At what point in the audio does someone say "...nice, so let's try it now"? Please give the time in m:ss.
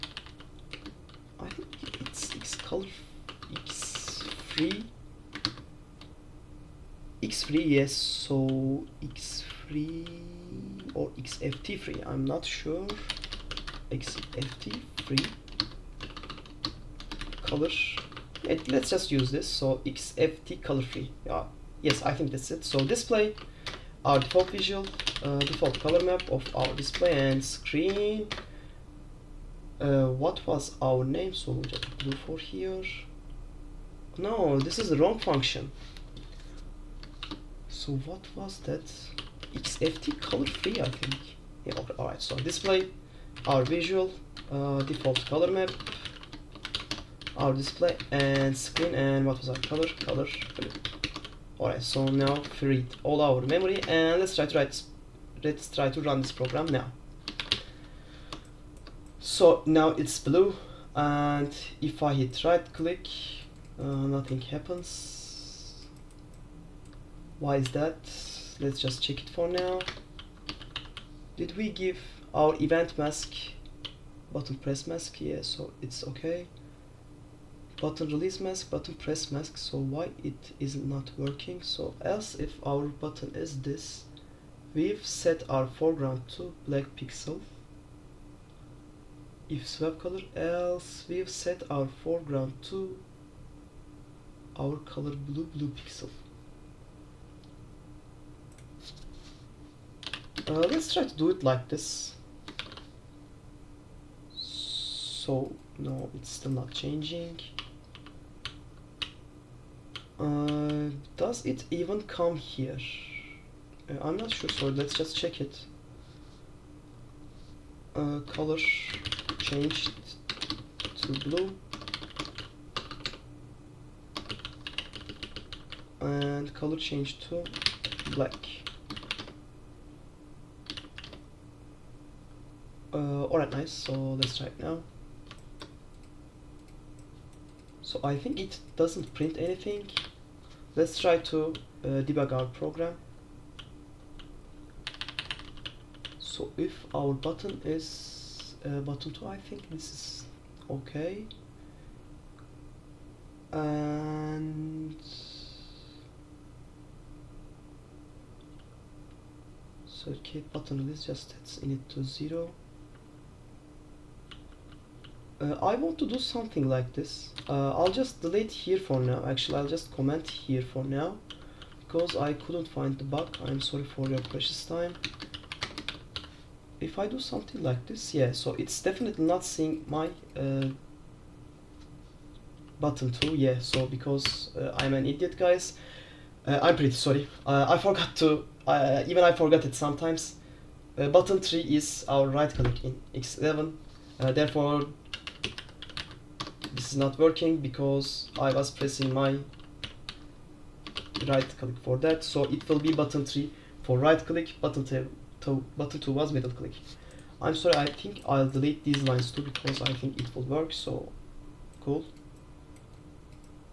2:13.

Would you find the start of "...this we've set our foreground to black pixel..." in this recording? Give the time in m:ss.
1:23.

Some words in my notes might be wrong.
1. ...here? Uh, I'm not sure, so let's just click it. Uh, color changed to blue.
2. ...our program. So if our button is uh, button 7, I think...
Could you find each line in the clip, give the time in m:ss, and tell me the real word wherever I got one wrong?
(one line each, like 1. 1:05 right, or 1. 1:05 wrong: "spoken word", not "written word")
1. 1:52 wrong: "check", not "click"
2. 2:22 wrong: "2", not "7".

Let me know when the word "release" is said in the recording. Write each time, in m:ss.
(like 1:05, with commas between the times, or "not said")
1:18.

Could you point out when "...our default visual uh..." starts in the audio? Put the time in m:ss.
0:24.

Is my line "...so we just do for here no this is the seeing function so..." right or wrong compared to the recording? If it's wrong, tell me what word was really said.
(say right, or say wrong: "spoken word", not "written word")
wrong: "wrong", not "seeing".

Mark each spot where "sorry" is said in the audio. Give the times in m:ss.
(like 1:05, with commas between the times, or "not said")
2:53, 3:06, 3:27.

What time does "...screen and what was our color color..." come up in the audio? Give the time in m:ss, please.
0:48.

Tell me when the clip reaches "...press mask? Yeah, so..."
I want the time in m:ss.
1:14.